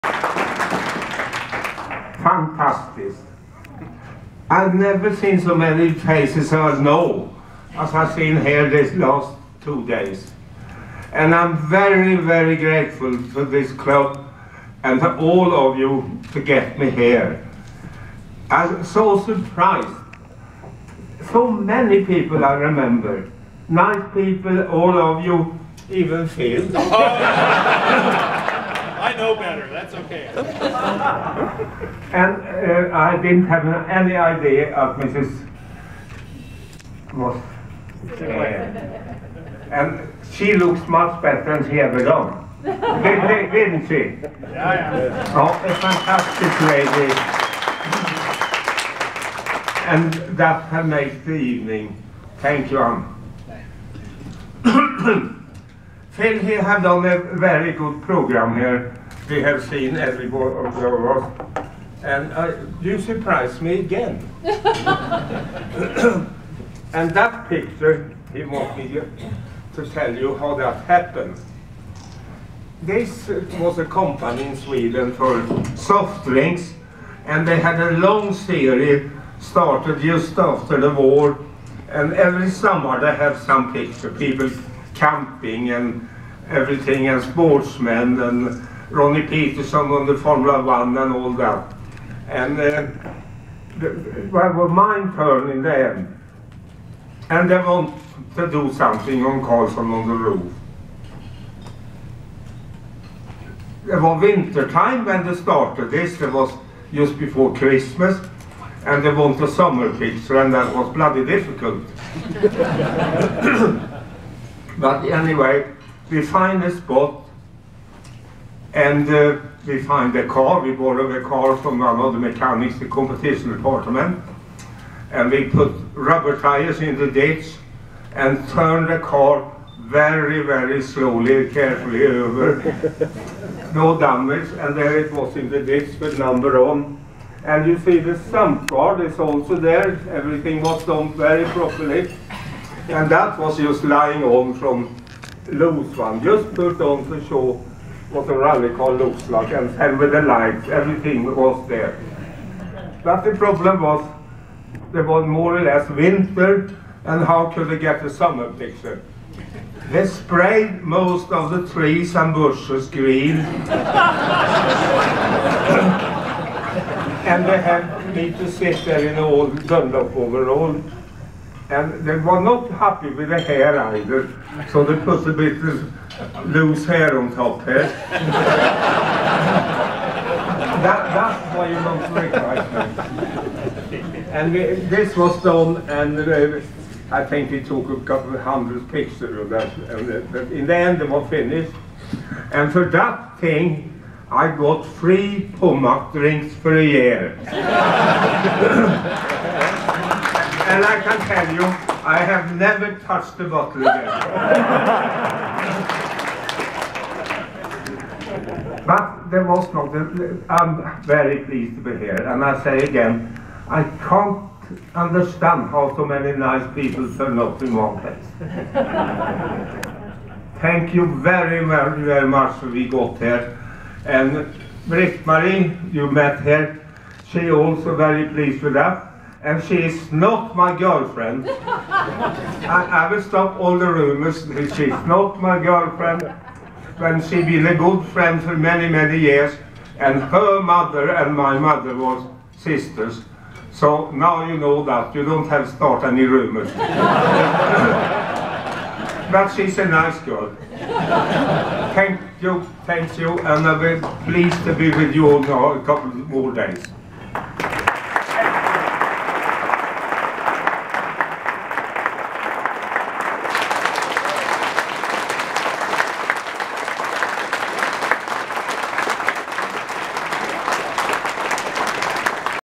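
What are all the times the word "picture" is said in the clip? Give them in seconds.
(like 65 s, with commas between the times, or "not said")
67 s, 83 s, 109 s, 158 s, 188 s.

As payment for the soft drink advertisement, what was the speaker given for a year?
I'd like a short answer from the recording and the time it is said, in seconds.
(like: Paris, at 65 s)
3 Pommac drinks, at 194 s.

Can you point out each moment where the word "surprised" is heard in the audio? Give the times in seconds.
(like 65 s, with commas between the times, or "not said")
19 s, 62 s.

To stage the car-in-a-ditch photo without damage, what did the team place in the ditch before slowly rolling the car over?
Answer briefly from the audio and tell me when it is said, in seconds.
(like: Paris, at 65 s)
Rubber tires, at 125 s.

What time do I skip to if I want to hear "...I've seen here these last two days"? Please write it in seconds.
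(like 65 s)
7 s.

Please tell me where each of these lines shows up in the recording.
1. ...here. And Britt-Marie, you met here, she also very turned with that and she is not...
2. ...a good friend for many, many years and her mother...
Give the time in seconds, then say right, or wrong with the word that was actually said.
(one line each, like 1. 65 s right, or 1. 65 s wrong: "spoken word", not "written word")
1. 223 s wrong: "pleased", not "turned"
2. 237 s right.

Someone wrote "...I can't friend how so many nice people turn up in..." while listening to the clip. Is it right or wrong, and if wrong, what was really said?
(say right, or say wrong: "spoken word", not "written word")
wrong: "understand", not "friend".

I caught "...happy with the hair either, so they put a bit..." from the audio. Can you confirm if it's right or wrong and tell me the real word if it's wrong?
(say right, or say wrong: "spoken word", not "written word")
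right.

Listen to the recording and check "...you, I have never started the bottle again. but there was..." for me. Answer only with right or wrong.
wrong.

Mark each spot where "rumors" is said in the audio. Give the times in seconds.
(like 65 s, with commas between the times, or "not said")
233 s, 246 s.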